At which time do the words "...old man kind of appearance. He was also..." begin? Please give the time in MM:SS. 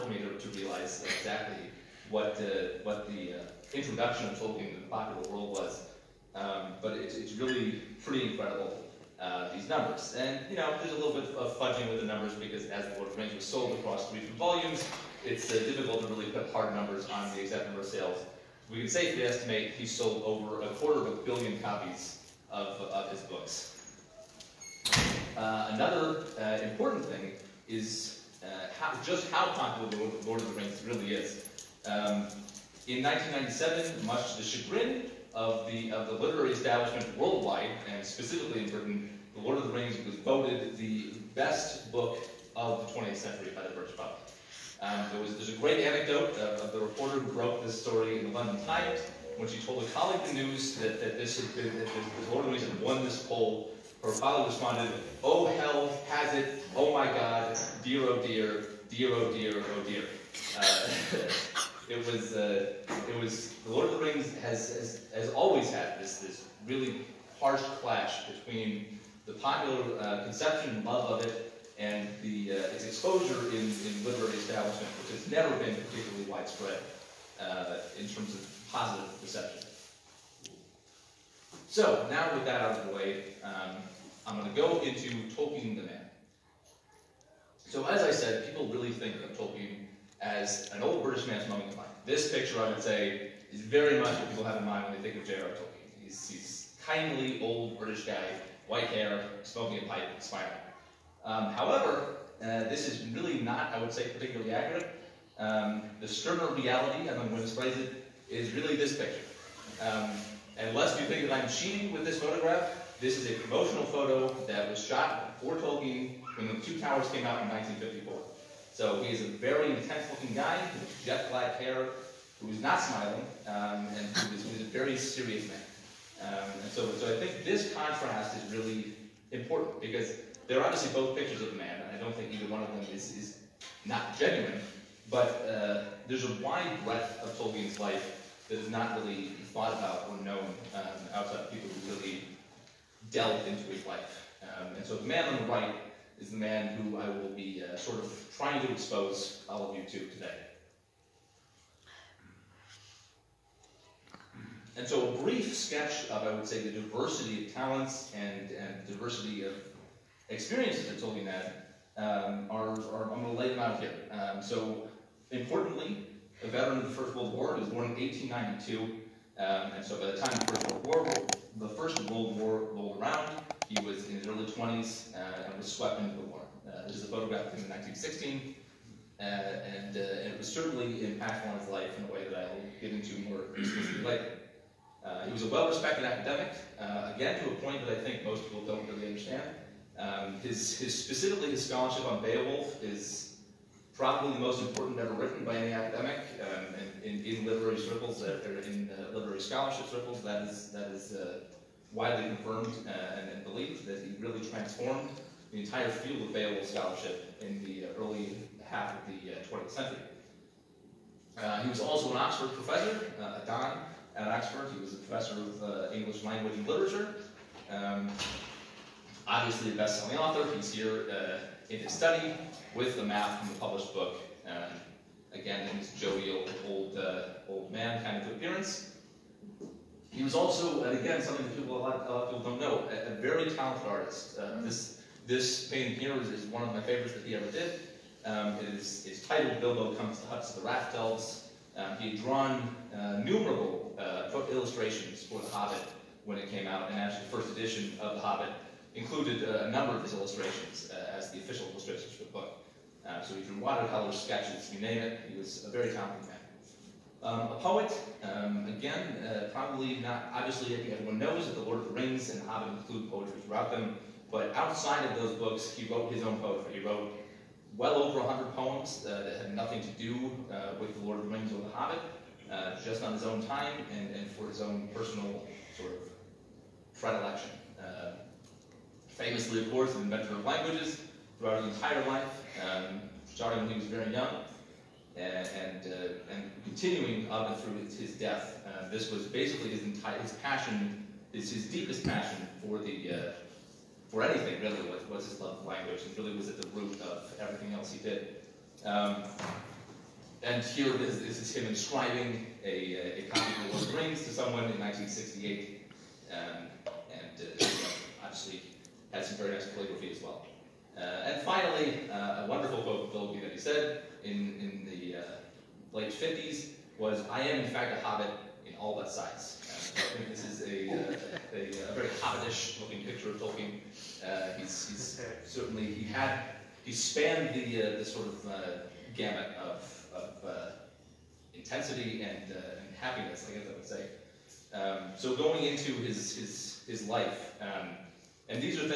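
03:47.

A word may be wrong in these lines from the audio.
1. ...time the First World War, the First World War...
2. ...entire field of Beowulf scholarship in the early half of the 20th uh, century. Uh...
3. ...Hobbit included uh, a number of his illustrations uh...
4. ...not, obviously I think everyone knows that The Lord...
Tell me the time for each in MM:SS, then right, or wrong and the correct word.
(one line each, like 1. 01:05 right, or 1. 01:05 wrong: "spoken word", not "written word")
1. 02:50 right
2. 03:25 right
3. 04:08 right
4. 04:19 right.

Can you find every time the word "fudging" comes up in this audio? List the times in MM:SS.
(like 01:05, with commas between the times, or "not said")
00:11.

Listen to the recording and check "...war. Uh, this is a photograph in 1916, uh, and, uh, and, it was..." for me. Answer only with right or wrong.
right.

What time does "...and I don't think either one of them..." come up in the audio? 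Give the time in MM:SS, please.
02:11.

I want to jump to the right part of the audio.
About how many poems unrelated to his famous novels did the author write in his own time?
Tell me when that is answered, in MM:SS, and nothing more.
04:27.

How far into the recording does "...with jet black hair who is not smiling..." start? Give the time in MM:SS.
02:00.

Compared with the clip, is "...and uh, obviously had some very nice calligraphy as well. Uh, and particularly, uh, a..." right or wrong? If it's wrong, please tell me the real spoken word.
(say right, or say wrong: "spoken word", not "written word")
wrong: "finally", not "particularly".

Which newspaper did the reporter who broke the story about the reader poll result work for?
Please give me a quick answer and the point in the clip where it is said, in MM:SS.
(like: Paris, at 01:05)
The London Times, at 00:48.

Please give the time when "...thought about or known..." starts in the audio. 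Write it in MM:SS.
02:19.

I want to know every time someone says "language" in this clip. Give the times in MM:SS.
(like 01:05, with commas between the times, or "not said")
03:36, 04:40, 04:55.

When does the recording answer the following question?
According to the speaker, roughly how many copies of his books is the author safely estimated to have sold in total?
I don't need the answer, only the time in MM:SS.
00:20.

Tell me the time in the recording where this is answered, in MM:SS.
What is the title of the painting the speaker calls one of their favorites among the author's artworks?
03:59.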